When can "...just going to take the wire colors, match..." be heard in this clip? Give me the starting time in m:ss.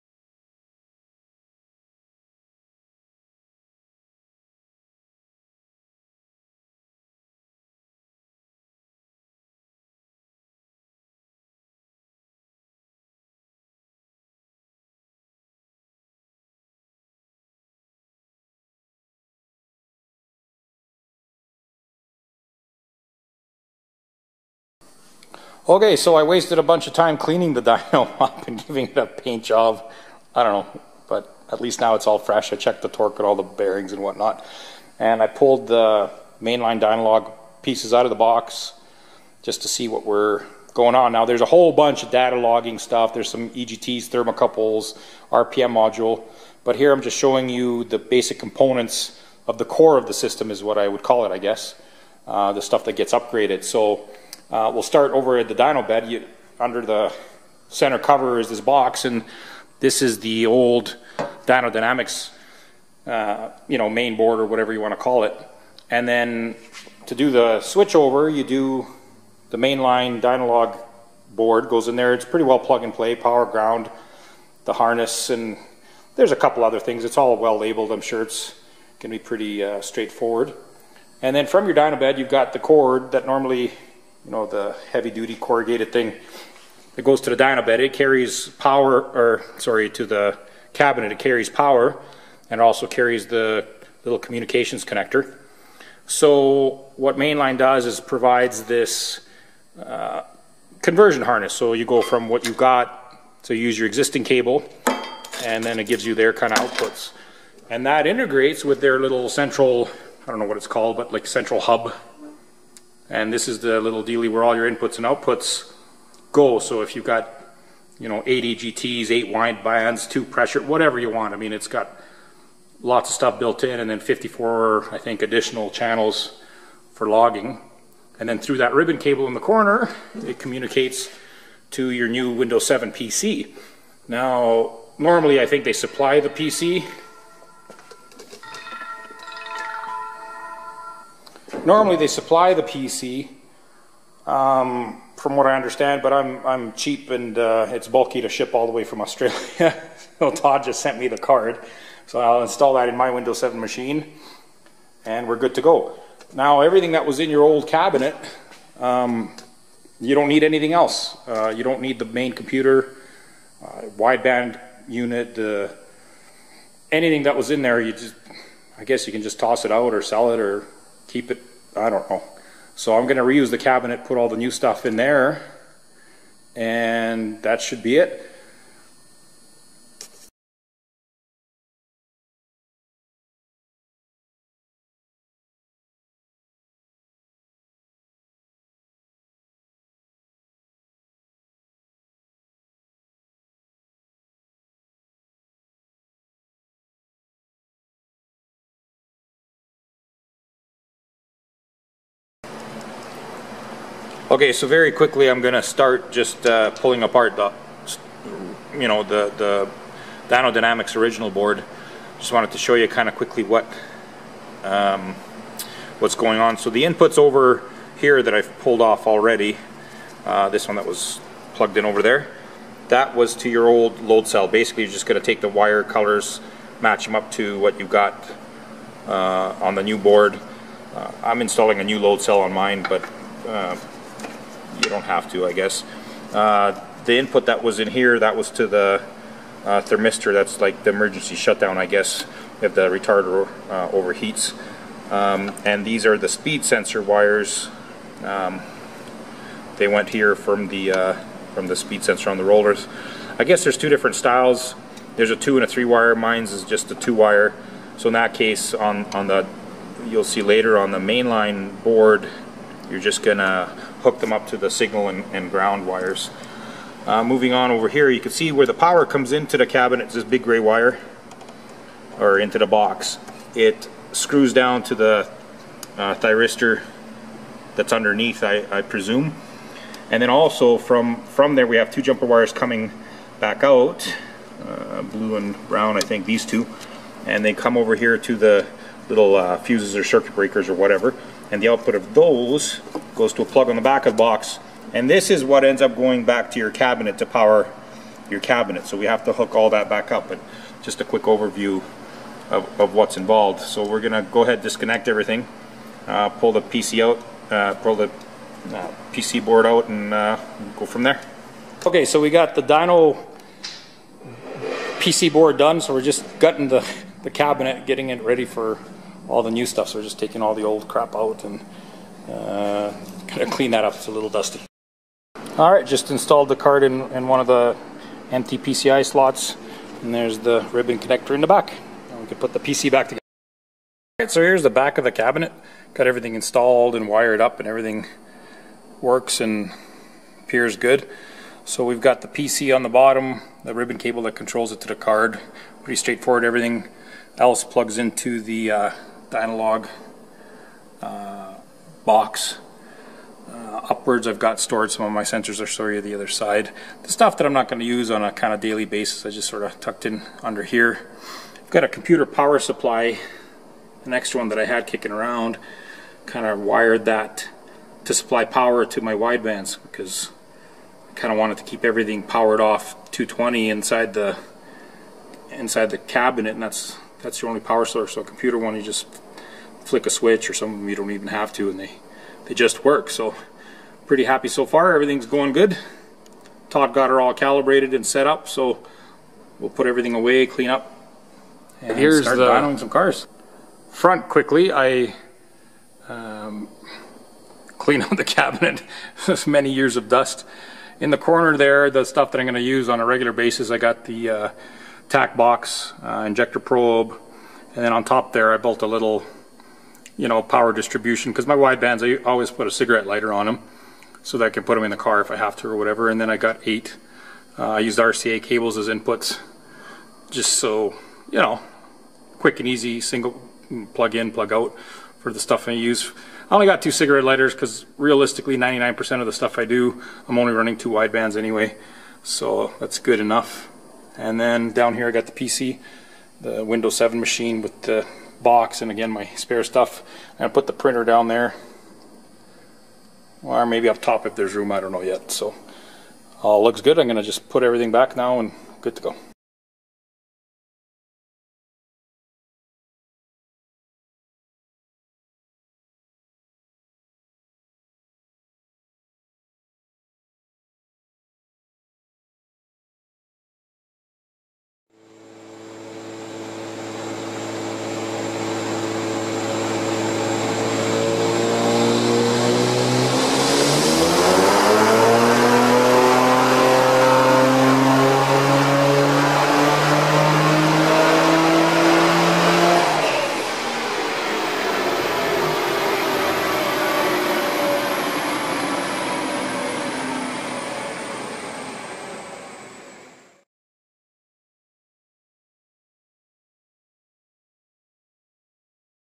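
3:44.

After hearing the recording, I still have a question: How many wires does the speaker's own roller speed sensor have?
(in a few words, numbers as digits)
2.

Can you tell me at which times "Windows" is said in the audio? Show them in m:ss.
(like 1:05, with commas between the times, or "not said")
2:12, 2:33, 7:16.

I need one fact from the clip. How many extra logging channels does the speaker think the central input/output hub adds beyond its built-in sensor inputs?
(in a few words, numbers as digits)
54.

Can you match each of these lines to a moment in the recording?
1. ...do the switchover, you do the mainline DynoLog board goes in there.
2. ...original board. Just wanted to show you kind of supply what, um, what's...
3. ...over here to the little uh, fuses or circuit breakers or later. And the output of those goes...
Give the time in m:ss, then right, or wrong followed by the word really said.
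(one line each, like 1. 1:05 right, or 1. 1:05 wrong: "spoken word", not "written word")
1. 1:07 right
2. 3:30 wrong: "quickly", not "supply"
3. 4:47 wrong: "whatever", not "later".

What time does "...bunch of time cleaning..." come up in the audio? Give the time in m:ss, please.
0:26.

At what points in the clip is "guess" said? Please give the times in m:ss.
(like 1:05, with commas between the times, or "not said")
0:51, 2:48, 3:55, 4:01, 4:13.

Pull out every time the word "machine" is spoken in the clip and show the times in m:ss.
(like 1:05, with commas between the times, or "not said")
2:33, 7:17.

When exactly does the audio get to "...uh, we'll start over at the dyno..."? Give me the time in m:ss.
0:54.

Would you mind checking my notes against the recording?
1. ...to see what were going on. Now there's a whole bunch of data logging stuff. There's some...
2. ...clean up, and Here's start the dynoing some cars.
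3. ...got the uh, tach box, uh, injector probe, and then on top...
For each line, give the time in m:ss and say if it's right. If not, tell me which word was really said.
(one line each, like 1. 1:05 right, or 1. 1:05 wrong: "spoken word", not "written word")
1. 0:39 right
2. 6:30 right
3. 6:43 right.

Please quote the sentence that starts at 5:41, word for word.
So we've got the PC on the bottom, the ribbon cable that controls it to the card.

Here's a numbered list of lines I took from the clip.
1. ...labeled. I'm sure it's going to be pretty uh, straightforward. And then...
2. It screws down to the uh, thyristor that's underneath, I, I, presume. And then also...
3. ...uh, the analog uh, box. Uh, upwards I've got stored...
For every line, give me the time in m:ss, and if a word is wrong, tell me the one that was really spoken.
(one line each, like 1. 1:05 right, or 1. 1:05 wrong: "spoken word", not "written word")
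1. 1:17 right
2. 4:33 right
3. 5:48 right.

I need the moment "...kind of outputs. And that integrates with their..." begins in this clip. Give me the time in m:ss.
1:46.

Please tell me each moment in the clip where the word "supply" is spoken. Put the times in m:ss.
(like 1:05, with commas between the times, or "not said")
2:15, 2:22, 6:02, 6:08.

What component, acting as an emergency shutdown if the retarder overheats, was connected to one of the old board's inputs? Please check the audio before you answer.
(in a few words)
Thermistor.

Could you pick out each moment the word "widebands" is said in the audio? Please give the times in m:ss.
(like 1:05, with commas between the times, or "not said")
2:43, 6:09, 6:51, 7:10.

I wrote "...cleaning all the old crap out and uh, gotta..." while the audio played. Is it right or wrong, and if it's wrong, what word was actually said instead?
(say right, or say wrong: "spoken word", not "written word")
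wrong: "taking", not "cleaning".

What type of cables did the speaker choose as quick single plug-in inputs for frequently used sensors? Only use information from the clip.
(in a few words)
RCA cables.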